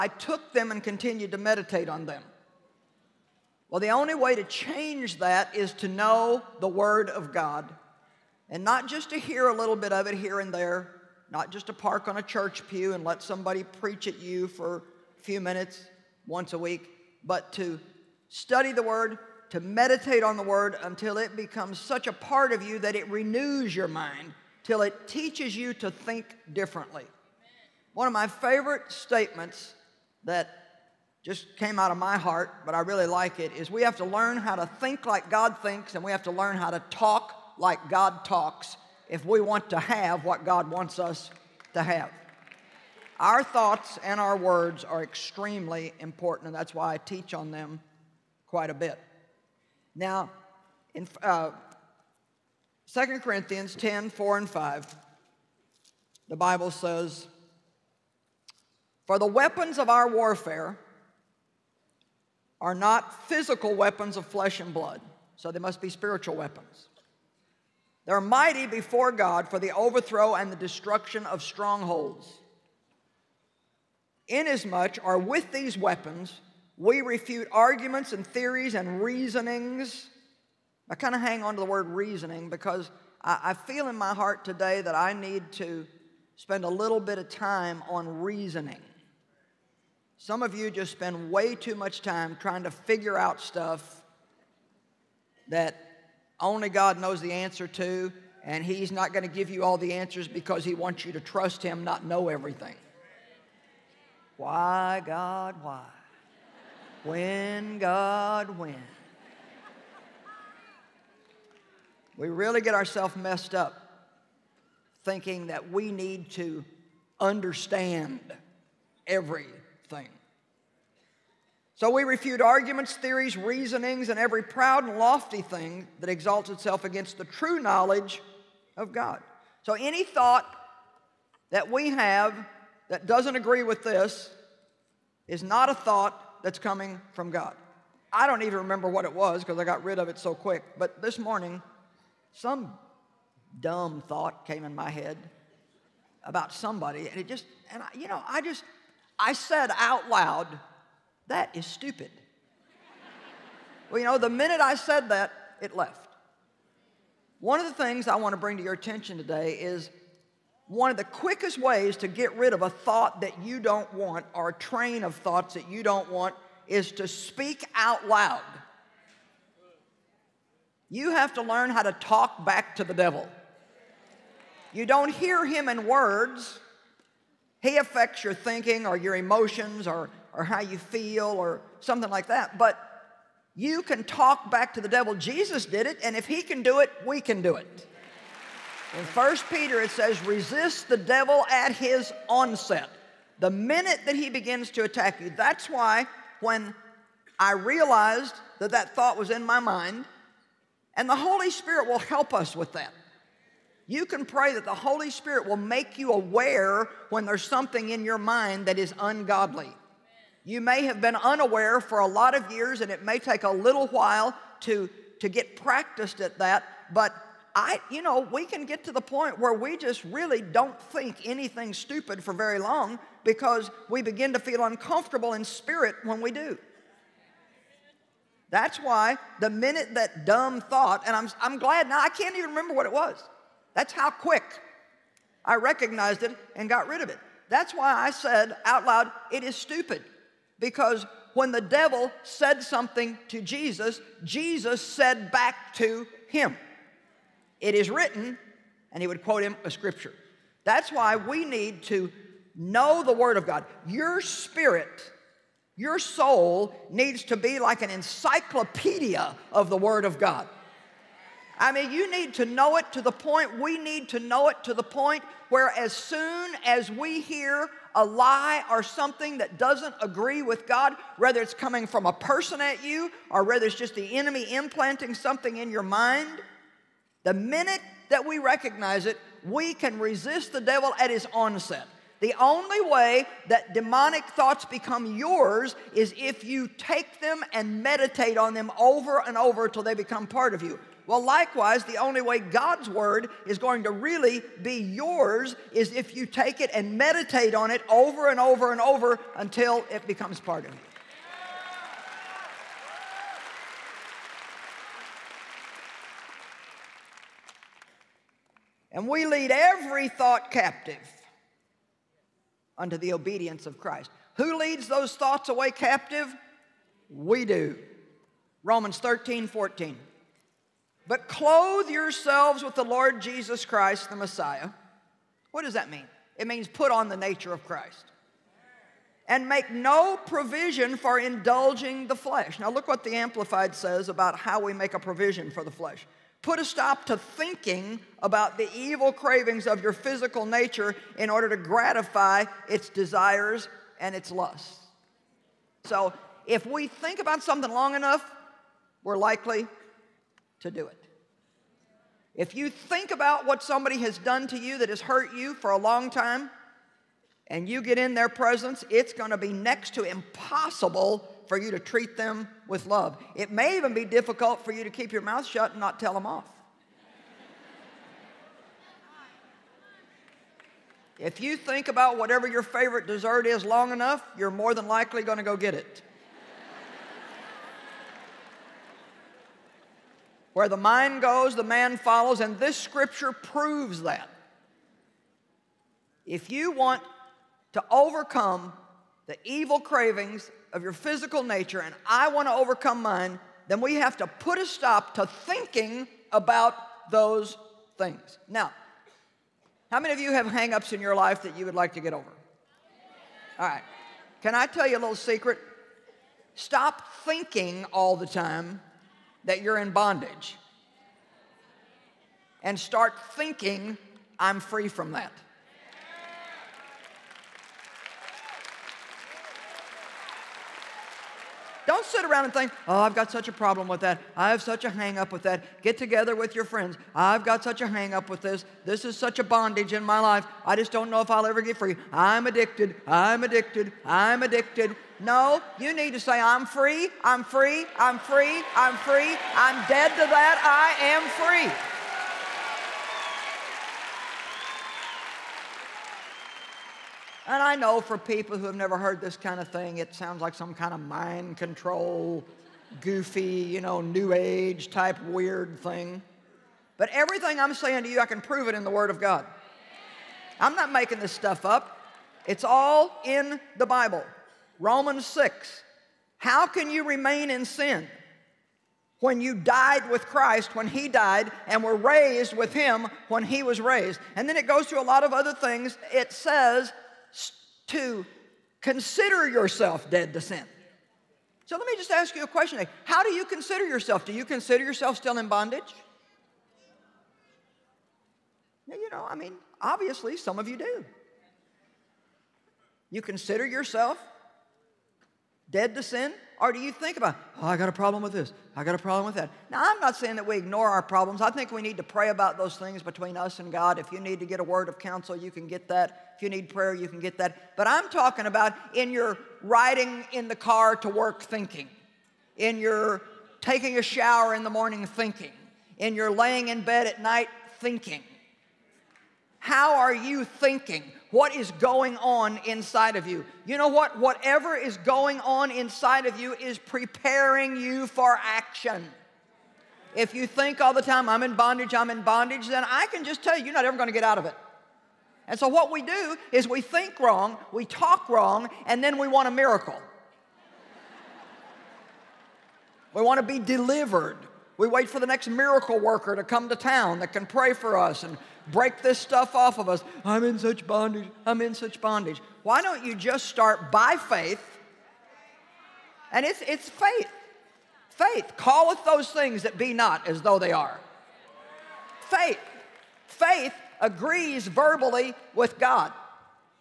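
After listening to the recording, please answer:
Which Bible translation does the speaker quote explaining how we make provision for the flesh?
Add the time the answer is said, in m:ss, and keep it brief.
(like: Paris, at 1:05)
The Amplified, at 5:33.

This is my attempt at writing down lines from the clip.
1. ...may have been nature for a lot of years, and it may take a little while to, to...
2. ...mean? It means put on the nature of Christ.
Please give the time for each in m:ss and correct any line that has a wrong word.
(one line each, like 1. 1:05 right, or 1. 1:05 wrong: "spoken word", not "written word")
1. 3:30 wrong: "unaware", not "nature"
2. 5:25 right.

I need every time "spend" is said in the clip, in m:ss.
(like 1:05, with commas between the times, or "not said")
1:26, 1:30.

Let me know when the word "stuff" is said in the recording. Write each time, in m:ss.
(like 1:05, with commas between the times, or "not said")
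1:33, 7:41, 9:09.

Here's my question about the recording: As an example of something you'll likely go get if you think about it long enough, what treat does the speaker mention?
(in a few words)
Favorite dessert.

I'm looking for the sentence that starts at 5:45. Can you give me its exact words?
So, if we think about something long enough, we're likely to do it.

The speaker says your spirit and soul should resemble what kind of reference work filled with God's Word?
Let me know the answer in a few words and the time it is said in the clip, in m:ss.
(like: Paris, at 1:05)
An encyclopedia, at 4:17.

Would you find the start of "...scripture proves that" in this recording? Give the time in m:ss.
6:22.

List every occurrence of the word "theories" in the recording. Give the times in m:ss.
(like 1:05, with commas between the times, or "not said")
1:18, 2:02.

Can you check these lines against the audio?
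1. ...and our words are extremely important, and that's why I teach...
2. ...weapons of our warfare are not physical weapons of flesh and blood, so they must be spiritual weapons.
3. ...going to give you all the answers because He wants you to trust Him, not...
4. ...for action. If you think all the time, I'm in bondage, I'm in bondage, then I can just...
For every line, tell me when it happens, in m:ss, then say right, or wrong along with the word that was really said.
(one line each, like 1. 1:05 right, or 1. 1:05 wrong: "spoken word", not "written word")
1. 0:44 right
2. 0:59 right
3. 1:39 right
4. 8:48 right.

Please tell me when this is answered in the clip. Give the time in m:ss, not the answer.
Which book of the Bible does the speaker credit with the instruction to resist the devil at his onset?
3:09.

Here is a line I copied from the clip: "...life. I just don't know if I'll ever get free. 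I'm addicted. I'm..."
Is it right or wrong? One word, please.
right.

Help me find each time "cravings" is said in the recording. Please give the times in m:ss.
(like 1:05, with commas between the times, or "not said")
5:39, 6:29.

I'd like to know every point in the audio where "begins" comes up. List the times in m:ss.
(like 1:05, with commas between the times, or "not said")
3:14, 3:44.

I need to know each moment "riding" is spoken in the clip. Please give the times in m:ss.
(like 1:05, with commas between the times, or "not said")
8:29.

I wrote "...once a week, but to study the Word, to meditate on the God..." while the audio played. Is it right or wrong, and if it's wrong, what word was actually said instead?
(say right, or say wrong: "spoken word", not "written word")
wrong: "Word", not "God".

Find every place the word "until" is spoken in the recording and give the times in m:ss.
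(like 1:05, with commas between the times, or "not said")
0:20, 4:49, 4:59.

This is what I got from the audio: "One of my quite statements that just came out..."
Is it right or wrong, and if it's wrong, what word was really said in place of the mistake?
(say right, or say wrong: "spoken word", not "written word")
wrong: "favorite", not "quite".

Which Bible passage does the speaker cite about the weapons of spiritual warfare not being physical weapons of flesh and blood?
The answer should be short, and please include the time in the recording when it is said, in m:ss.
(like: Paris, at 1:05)
2 Corinthians 10:4-5, at 0:52.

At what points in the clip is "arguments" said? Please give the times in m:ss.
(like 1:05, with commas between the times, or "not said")
1:17, 2:02.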